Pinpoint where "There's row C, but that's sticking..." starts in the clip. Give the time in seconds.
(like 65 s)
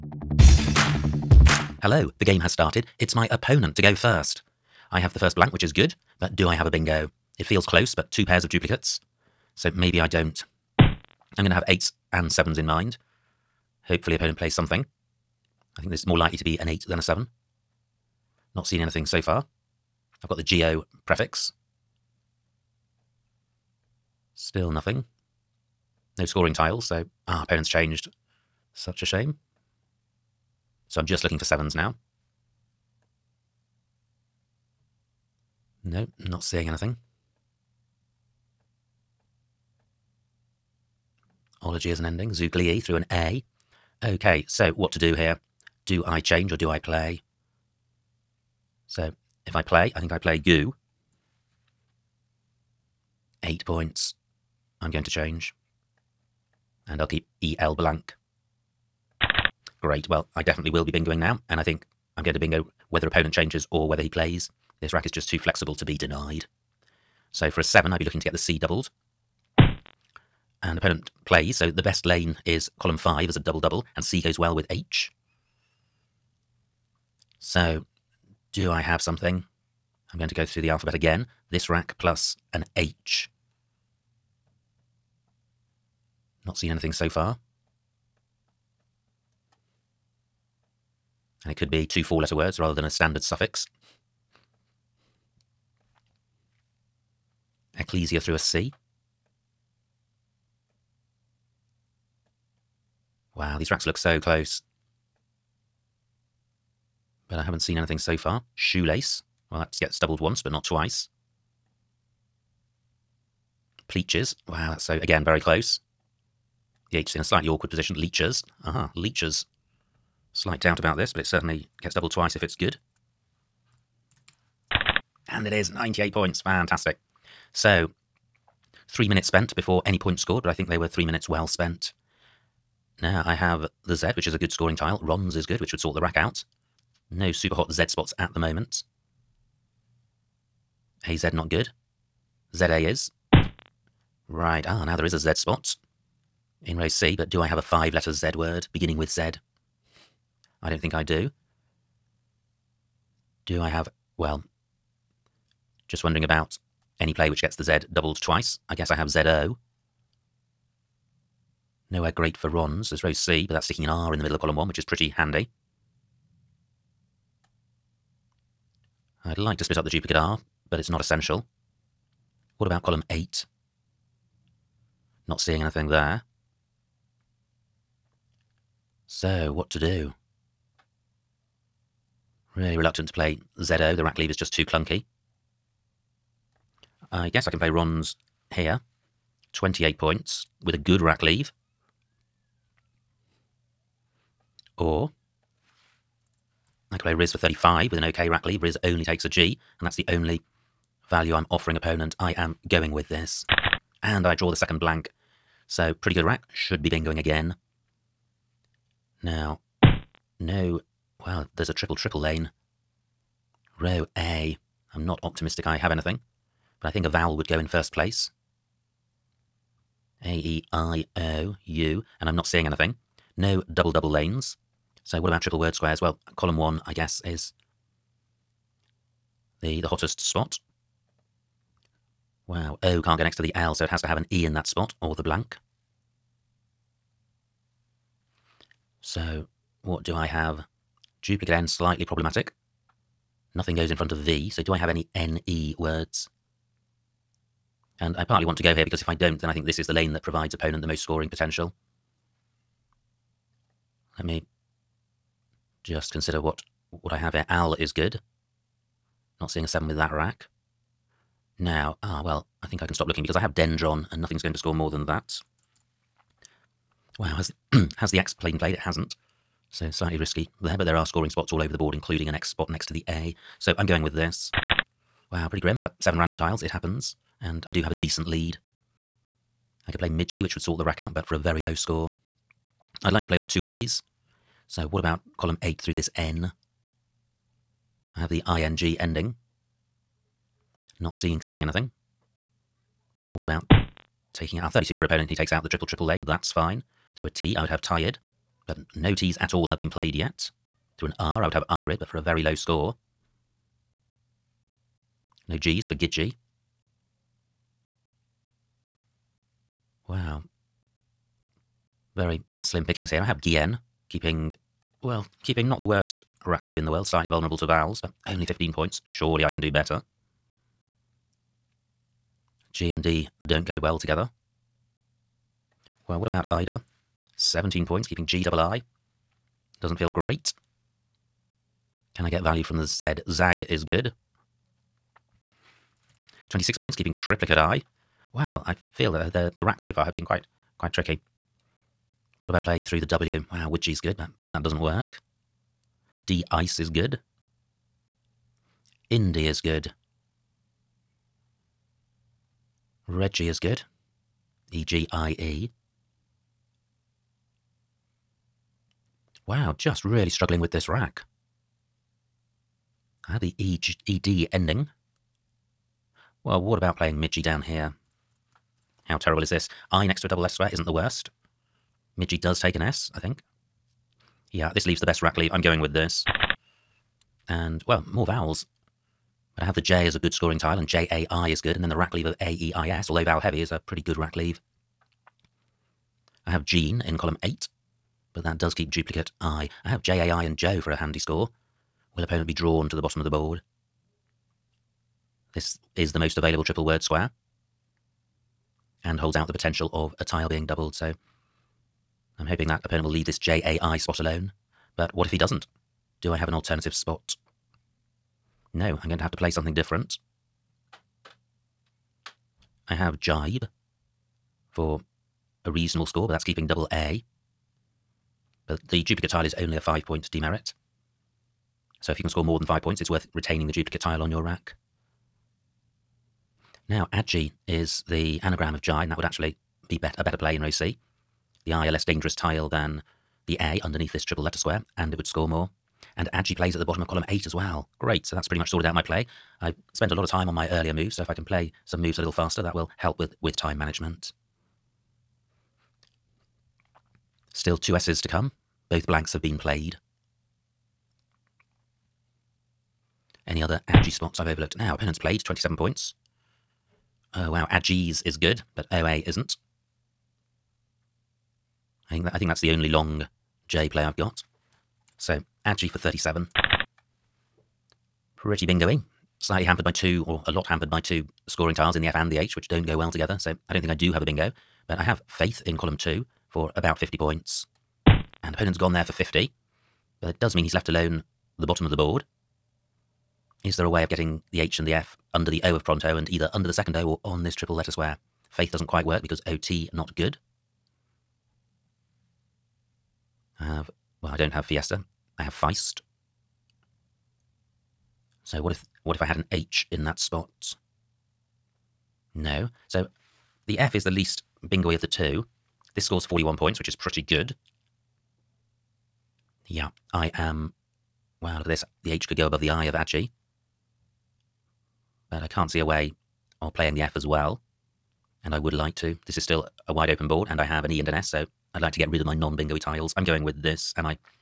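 162 s.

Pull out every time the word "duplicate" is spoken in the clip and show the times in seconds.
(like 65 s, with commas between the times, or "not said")
8 s, 169 s, 241 s, 388 s, 419 s, 423 s.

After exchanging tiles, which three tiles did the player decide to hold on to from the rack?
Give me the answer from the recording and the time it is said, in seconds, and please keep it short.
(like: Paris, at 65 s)
EL blank, at 57 s.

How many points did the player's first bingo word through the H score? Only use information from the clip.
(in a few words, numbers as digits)
98.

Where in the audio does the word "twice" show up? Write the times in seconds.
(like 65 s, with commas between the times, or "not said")
110 s, 122 s, 158 s.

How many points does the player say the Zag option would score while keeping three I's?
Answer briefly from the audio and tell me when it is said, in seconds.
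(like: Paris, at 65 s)
26, at 336 s.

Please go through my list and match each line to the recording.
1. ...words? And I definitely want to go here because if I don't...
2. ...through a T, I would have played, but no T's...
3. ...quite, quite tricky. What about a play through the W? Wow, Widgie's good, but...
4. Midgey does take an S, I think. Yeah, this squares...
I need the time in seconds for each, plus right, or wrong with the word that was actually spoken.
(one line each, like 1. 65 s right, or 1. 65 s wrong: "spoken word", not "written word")
1. 245 s wrong: "partly", not "definitely"
2. 297 s wrong: "tired", not "played"
3. 340 s right
4. 372 s wrong: "leaves", not "squares".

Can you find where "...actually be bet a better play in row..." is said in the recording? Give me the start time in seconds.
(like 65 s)
429 s.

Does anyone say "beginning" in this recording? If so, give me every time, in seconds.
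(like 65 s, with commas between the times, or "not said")
148 s.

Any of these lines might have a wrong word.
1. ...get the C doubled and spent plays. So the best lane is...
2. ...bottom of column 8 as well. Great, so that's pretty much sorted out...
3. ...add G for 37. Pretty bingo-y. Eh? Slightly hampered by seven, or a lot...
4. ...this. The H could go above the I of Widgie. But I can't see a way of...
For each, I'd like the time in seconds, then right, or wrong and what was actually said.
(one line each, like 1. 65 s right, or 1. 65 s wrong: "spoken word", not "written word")
1. 68 s wrong: "opponent", not "spent"
2. 436 s right
3. 465 s wrong: "two", not "seven"
4. 511 s wrong: "Adji", not "Widgie".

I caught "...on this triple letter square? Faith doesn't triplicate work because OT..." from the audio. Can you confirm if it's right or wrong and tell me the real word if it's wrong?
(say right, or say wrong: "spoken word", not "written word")
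wrong: "quite", not "triplicate".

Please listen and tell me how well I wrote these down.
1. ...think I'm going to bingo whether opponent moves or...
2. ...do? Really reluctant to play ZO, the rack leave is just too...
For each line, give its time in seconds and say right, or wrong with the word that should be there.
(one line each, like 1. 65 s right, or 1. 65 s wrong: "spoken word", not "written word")
1. 61 s wrong: "changes", not "moves"
2. 179 s right.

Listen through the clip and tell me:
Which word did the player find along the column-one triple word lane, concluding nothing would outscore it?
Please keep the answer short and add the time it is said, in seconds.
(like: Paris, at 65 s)
Dendron, at 263 s.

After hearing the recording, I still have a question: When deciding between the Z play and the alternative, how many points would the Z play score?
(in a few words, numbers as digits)
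35.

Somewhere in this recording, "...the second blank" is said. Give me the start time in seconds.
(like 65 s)
204 s.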